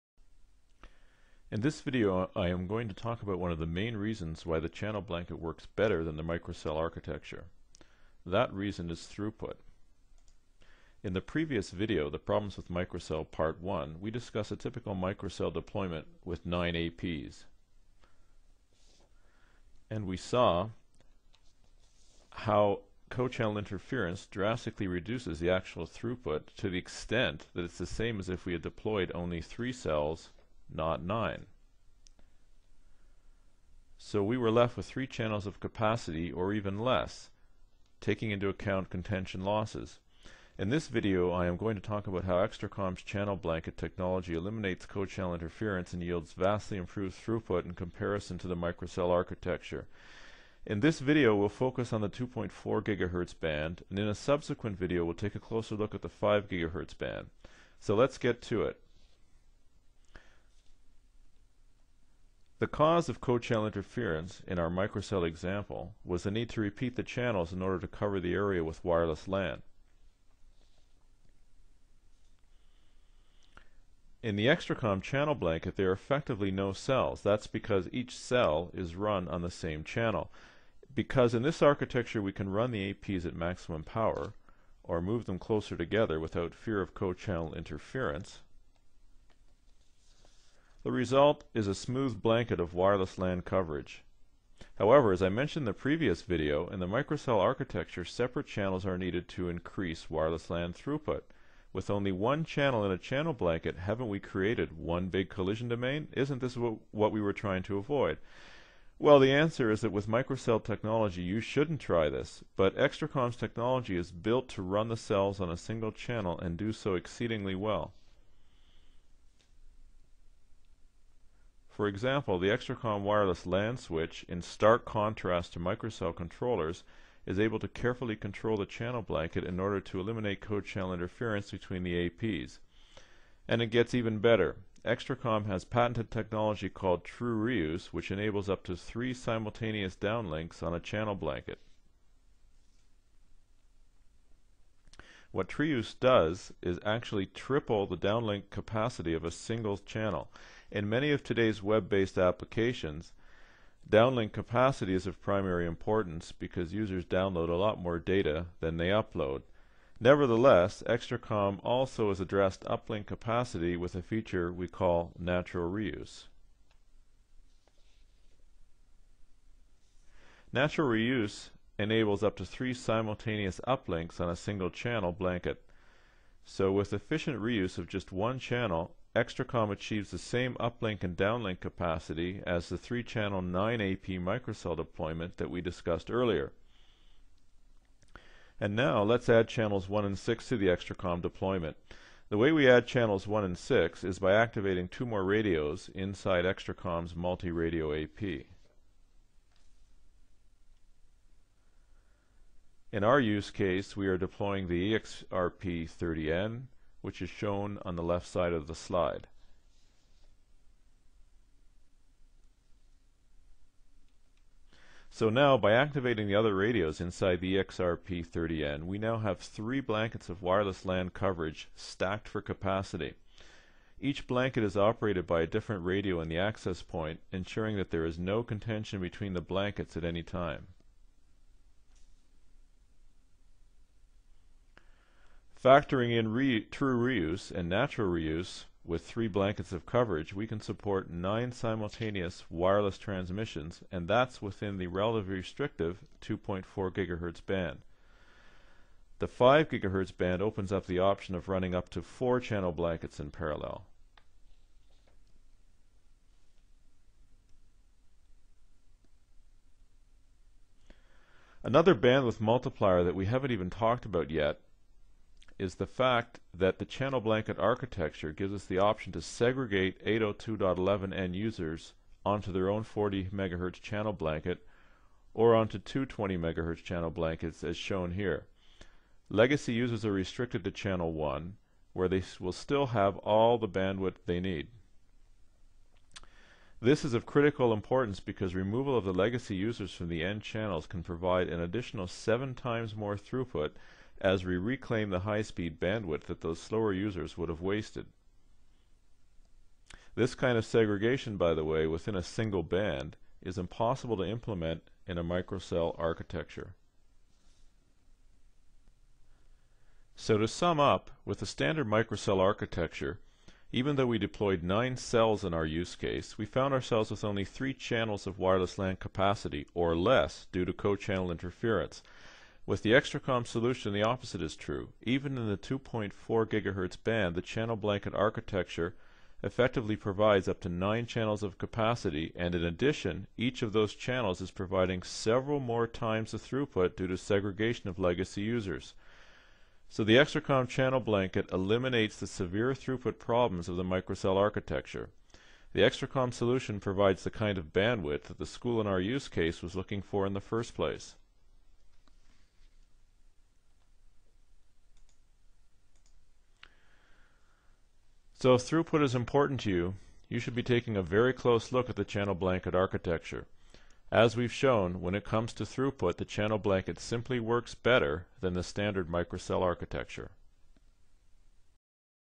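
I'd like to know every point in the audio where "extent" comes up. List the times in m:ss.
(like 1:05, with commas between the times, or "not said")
0:26.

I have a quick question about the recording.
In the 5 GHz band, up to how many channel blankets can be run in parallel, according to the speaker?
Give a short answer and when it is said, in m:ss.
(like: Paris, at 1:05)
4, at 4:12.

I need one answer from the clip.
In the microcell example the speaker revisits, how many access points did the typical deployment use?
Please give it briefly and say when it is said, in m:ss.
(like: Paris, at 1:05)
9, at 0:16.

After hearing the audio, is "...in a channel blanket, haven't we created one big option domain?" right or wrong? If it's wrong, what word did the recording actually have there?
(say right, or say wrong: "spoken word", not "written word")
wrong: "collision", not "option".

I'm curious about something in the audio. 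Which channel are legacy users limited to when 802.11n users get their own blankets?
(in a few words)
channel 1.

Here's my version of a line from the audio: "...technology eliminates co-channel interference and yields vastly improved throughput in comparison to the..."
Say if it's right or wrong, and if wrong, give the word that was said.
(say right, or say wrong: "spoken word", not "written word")
right.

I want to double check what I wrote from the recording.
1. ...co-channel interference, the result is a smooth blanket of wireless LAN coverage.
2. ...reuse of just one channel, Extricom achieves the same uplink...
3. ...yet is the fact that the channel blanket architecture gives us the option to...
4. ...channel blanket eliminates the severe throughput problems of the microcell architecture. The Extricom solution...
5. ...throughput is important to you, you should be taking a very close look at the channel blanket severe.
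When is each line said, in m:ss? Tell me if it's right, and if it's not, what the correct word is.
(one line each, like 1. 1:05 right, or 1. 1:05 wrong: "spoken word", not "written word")
1. 1:26 right
2. 2:57 right
3. 4:24 right
4. 5:40 right
5. 5:58 wrong: "architecture", not "severe".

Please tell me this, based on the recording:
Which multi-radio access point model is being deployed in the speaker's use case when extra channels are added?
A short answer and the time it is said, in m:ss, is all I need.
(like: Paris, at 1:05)
EXRP30N, at 3:24.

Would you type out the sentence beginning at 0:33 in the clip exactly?
So we were left with three channels of capacity or even less, taking into account contention losses.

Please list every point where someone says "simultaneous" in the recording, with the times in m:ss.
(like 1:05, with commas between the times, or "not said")
2:19, 2:52, 4:01.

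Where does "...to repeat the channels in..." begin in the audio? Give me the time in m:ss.
1:06.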